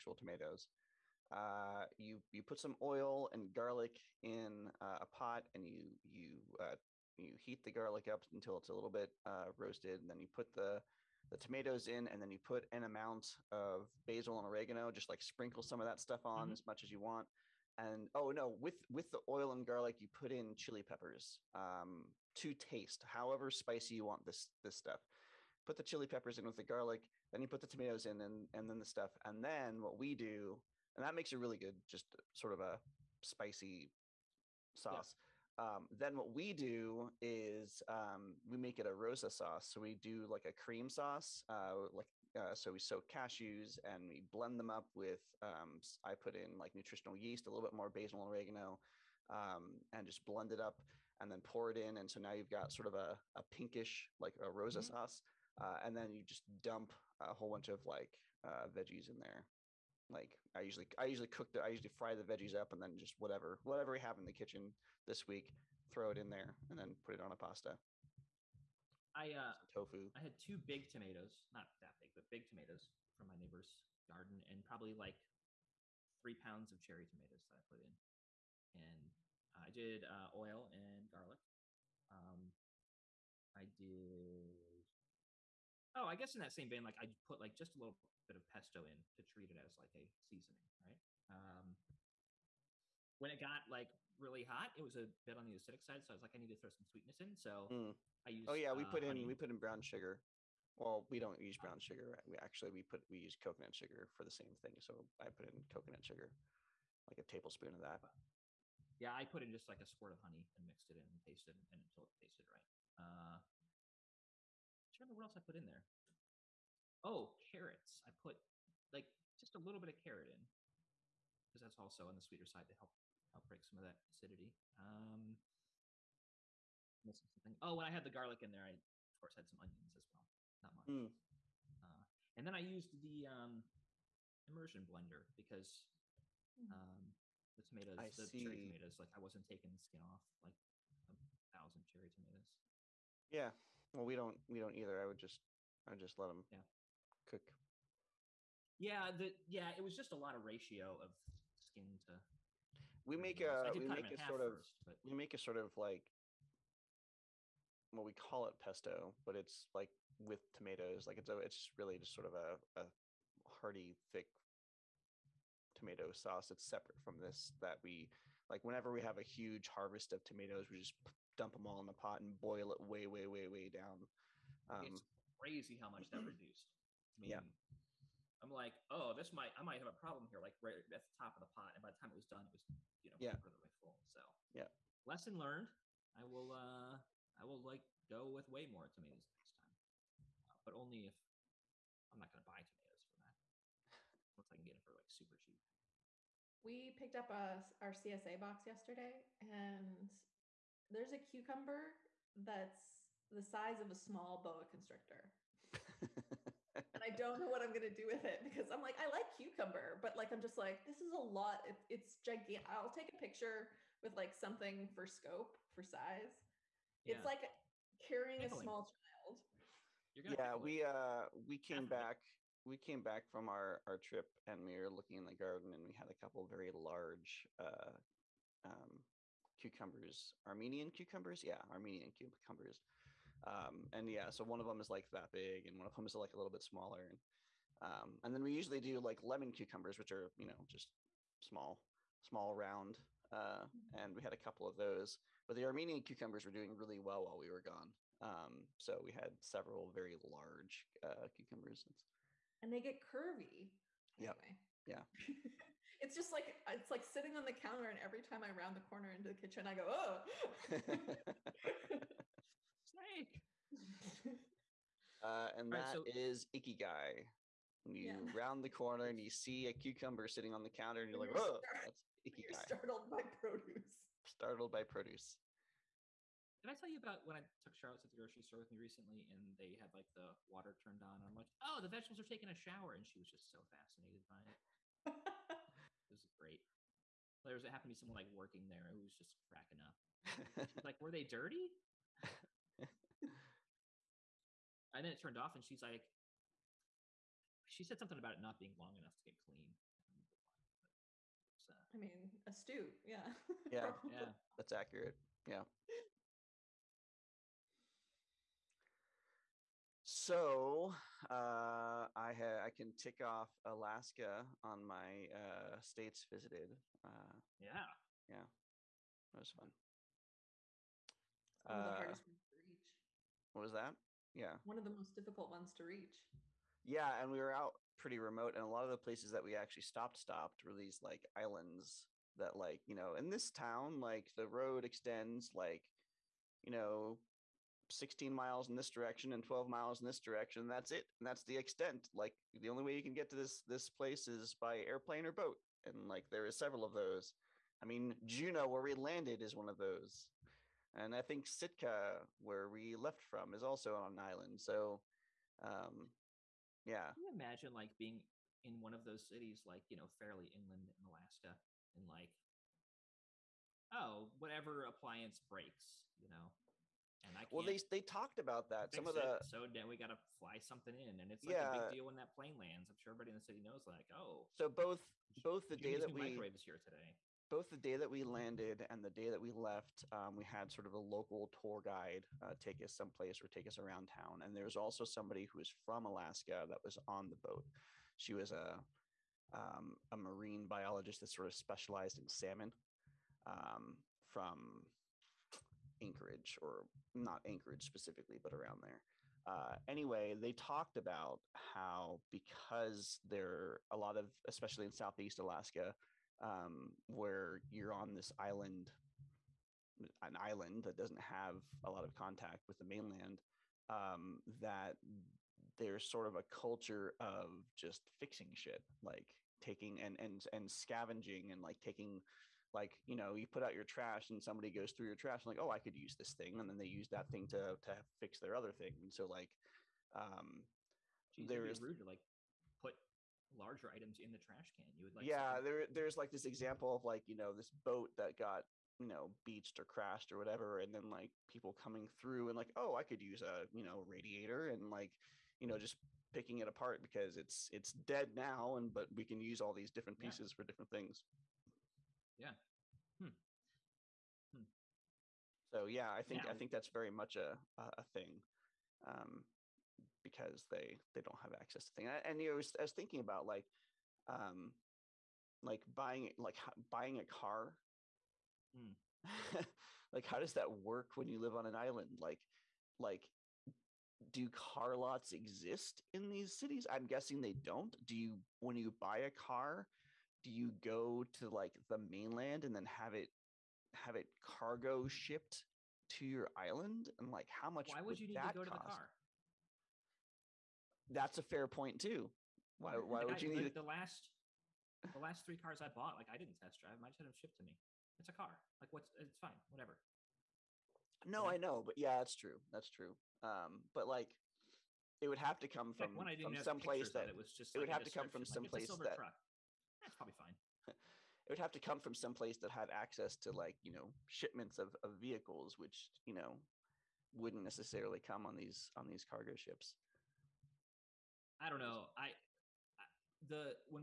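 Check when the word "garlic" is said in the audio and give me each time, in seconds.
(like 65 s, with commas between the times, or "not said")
3 s, 7 s, 19 s, 26 s, 81 s, 128 s.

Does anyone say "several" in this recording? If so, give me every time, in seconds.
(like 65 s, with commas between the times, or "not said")
249 s, 346 s.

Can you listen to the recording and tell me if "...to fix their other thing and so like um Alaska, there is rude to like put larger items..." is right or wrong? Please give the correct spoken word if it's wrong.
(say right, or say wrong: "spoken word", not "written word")
wrong: "Jeez", not "Alaska".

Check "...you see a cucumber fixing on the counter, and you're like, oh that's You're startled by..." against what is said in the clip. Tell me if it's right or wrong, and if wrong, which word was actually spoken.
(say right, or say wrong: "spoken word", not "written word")
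wrong: "sitting", not "fixing".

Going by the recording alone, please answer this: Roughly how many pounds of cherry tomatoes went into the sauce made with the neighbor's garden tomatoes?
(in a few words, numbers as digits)
3.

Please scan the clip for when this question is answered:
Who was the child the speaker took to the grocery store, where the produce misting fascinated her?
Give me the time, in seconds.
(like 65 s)
277 s.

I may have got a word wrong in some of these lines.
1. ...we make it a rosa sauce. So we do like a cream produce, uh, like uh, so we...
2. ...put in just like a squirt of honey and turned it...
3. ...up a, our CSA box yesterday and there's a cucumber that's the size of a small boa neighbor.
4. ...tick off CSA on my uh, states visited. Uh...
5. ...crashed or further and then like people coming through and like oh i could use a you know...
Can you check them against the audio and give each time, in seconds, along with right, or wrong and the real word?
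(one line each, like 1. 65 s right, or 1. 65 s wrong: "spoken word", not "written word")
1. 38 s wrong: "sauce", not "produce"
2. 109 s wrong: "mixed", not "turned"
3. 197 s wrong: "constrictor", not "neighbor"
4. 312 s wrong: "Alaska", not "CSA"
5. 439 s wrong: "whatever", not "further".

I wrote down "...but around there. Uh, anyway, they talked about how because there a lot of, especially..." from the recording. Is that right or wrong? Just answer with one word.
right.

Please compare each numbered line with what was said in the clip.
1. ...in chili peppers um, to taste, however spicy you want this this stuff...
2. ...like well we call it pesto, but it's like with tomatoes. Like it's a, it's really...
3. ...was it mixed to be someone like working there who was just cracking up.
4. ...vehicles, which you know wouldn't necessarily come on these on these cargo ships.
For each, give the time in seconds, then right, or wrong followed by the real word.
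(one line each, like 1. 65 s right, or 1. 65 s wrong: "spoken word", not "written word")
1. 20 s right
2. 155 s right
3. 287 s wrong: "happened", not "mixed"
4. 515 s right.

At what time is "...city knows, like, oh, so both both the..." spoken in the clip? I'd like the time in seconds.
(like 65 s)
373 s.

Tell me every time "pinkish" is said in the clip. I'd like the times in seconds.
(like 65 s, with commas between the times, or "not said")
53 s.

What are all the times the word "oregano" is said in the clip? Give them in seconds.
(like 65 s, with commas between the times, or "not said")
14 s, 48 s.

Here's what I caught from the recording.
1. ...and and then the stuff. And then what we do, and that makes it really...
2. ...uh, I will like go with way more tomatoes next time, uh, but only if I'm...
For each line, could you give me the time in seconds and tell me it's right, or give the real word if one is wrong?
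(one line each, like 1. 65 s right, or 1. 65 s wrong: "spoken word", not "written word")
1. 28 s right
2. 186 s right.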